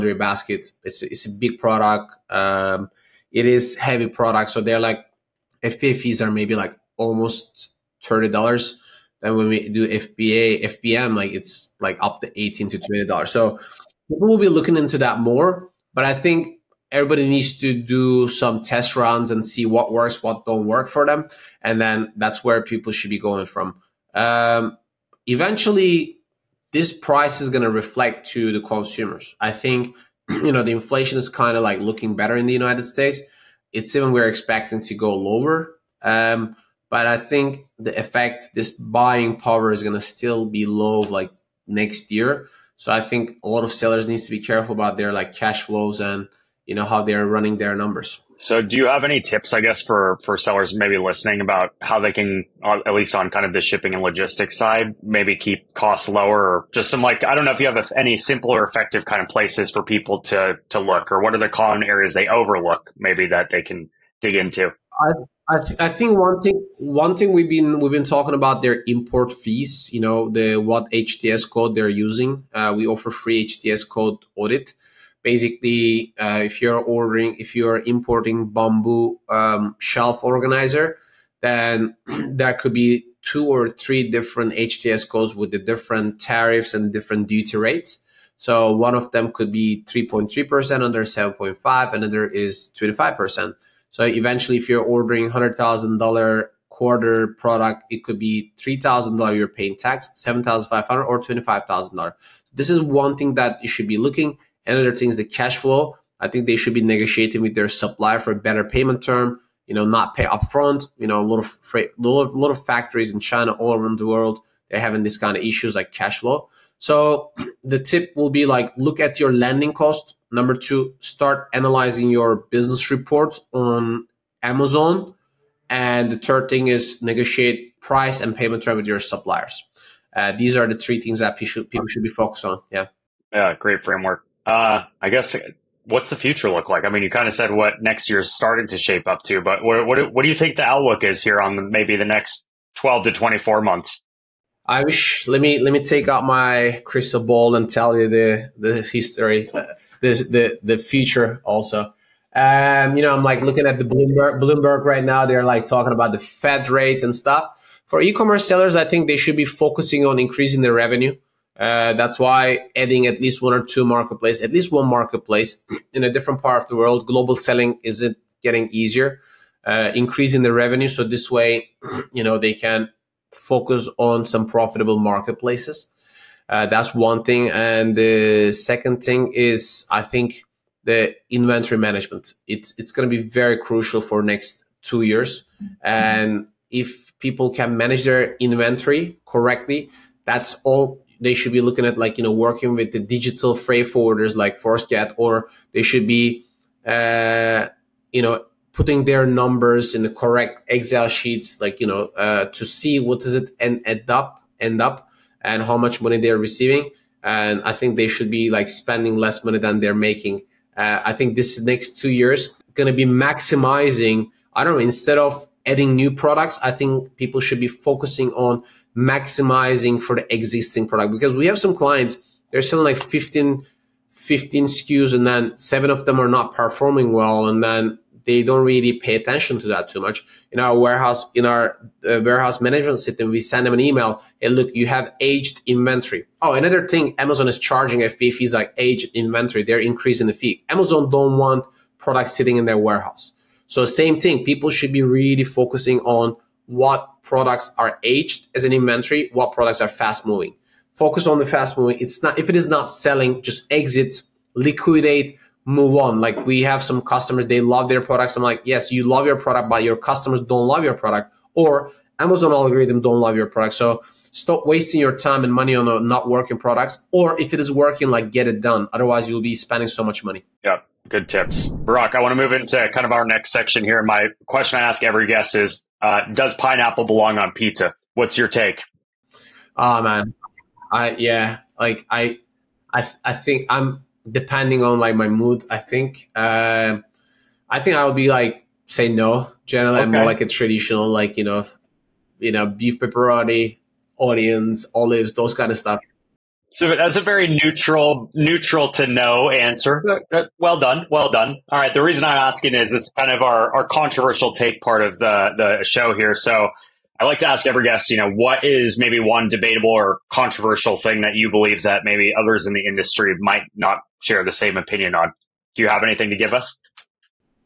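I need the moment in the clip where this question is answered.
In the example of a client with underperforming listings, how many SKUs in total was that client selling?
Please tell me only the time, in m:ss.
3:43.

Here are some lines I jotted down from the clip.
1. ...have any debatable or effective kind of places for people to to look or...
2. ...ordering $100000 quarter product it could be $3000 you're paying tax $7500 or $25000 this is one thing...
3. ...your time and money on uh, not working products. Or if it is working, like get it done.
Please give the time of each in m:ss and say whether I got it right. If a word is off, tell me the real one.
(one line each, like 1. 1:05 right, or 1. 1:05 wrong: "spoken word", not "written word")
1. 0:57 wrong: "simple", not "debatable"
2. 1:34 right
3. 4:24 right.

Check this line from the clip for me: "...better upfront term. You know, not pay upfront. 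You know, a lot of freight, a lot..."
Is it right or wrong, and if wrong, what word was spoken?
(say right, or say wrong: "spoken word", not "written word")
wrong: "payment", not "upfront".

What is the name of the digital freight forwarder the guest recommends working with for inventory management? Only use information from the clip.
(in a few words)
Forceget.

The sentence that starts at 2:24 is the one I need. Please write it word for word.
I wish let me let me take out my crystal ball and tell you the the history, the the the future also.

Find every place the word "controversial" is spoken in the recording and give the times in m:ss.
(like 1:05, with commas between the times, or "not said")
5:03, 5:10.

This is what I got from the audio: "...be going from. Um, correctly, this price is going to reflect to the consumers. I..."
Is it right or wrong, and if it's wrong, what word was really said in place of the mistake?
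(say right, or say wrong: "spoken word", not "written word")
wrong: "eventually", not "correctly".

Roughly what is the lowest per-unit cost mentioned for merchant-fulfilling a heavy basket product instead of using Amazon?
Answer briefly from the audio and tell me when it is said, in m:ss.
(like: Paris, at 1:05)
18 dollars, at 0:12.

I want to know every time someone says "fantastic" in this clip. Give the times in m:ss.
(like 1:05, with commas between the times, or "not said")
not said.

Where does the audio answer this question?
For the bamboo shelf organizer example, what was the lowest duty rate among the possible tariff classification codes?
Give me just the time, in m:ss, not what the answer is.
1:29.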